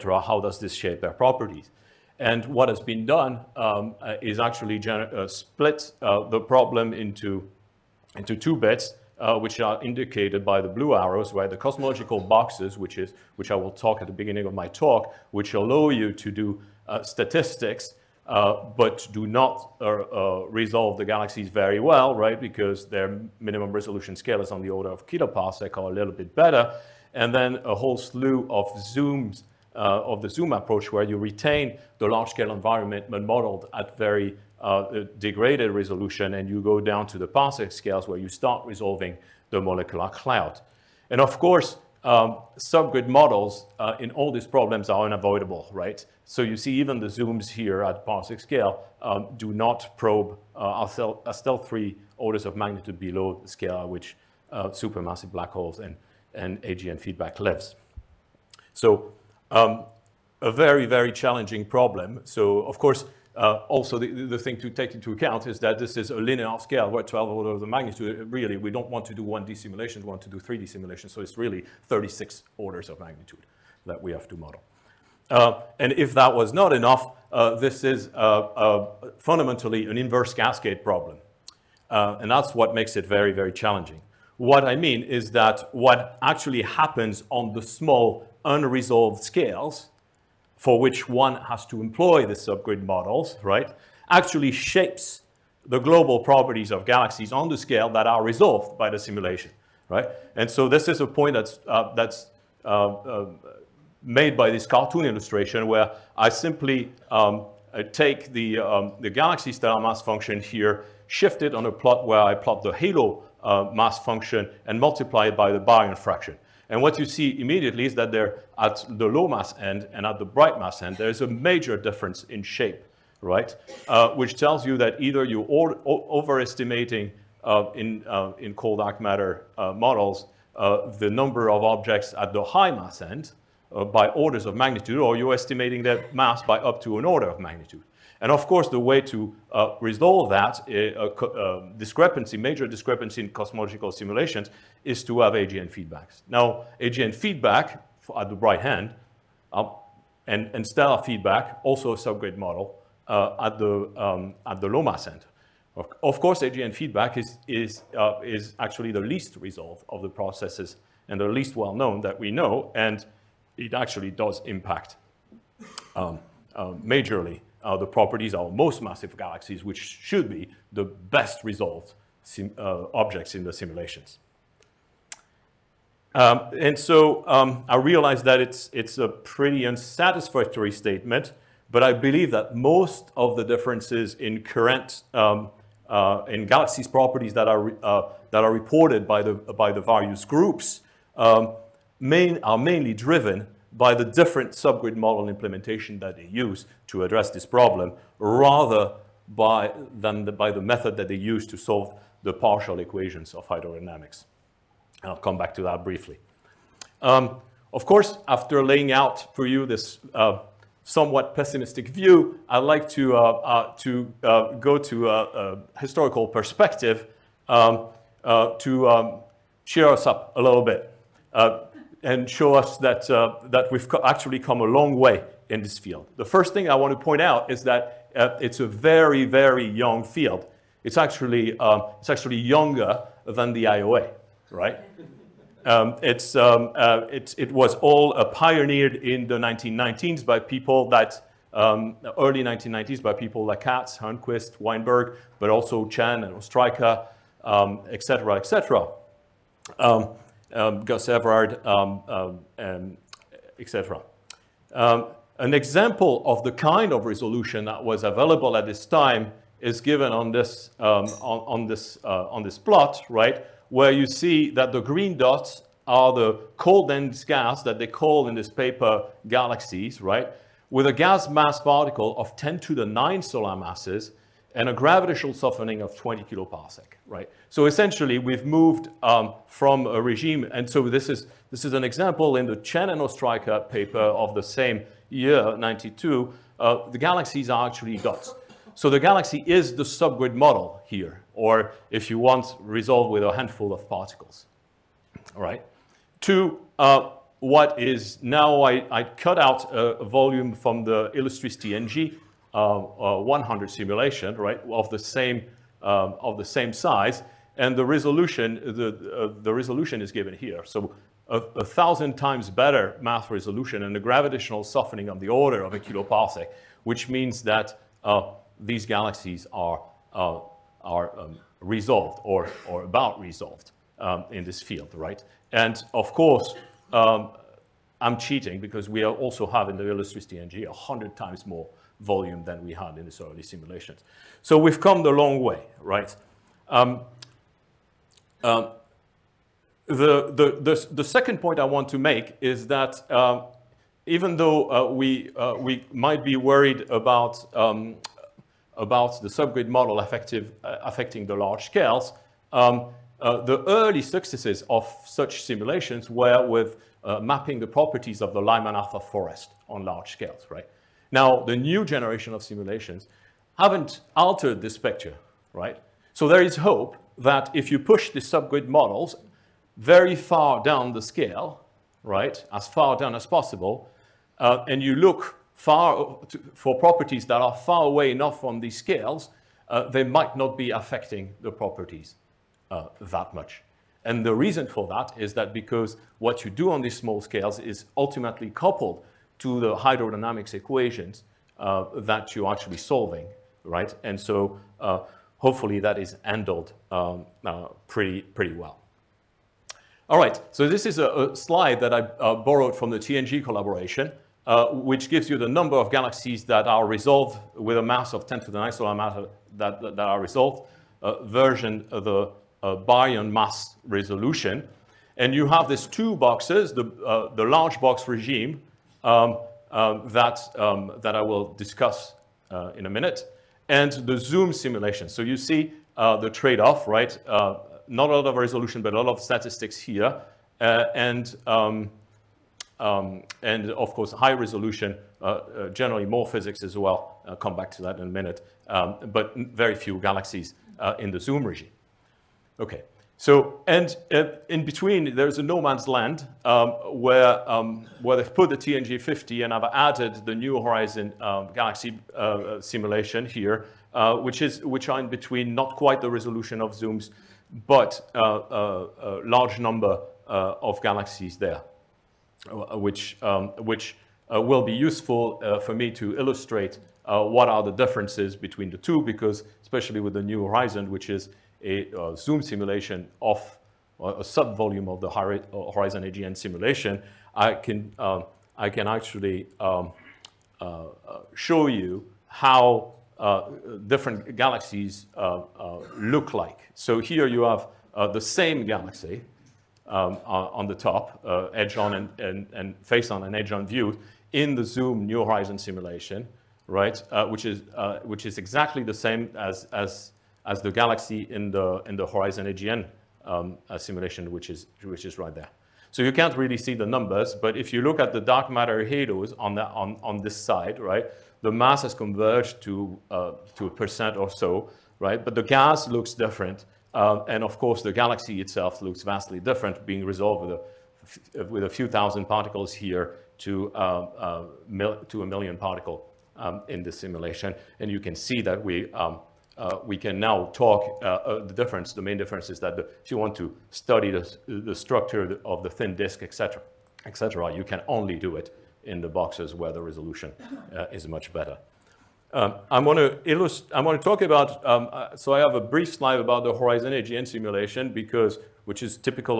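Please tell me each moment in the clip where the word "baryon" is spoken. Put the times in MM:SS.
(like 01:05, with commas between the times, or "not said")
01:55, 06:52.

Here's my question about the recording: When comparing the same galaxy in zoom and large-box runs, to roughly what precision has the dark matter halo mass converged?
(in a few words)
A percent.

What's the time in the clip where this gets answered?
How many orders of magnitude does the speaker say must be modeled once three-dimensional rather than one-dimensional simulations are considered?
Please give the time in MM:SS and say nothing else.
01:11.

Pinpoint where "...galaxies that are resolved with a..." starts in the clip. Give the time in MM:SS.
06:45.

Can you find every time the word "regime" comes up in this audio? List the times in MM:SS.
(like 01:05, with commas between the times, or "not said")
04:40, 06:58, 07:21.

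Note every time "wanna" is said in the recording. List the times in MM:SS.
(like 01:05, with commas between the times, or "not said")
not said.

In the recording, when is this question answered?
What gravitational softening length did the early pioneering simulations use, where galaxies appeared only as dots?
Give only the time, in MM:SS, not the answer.
04:35.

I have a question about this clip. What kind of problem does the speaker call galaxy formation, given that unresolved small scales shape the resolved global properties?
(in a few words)
Inverse cascade problem.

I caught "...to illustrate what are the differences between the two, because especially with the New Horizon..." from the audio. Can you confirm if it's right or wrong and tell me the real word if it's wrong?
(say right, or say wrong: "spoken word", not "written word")
right.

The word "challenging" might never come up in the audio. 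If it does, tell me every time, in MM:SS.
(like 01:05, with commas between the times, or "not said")
01:01, 01:23.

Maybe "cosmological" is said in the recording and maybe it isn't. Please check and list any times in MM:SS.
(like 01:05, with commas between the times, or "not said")
00:11, 02:23.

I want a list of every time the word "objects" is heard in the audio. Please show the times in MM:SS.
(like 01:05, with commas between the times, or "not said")
02:11, 02:52.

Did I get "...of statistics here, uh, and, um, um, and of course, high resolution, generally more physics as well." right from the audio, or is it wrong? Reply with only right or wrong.
right.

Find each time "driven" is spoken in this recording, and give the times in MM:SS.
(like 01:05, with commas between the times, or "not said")
03:12.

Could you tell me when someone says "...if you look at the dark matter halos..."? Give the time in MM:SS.
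08:27.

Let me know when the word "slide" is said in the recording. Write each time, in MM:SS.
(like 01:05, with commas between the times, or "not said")
06:41, 09:05.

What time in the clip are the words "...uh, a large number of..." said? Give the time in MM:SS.
07:38.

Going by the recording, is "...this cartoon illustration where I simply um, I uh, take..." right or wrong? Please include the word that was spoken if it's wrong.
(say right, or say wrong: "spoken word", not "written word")
right.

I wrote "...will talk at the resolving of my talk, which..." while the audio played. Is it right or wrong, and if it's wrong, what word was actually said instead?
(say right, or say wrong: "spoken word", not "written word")
wrong: "beginning", not "resolving".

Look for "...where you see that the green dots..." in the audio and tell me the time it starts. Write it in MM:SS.
04:23.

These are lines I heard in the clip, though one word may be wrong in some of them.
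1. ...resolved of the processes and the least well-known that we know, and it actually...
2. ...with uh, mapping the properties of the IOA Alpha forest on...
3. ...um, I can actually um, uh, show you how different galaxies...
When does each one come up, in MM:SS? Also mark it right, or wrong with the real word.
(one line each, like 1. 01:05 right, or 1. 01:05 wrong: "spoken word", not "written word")
1. 02:39 right
2. 05:56 wrong: "Lyman", not "IOA"
3. 07:57 right.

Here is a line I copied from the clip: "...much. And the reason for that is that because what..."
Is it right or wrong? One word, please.
right.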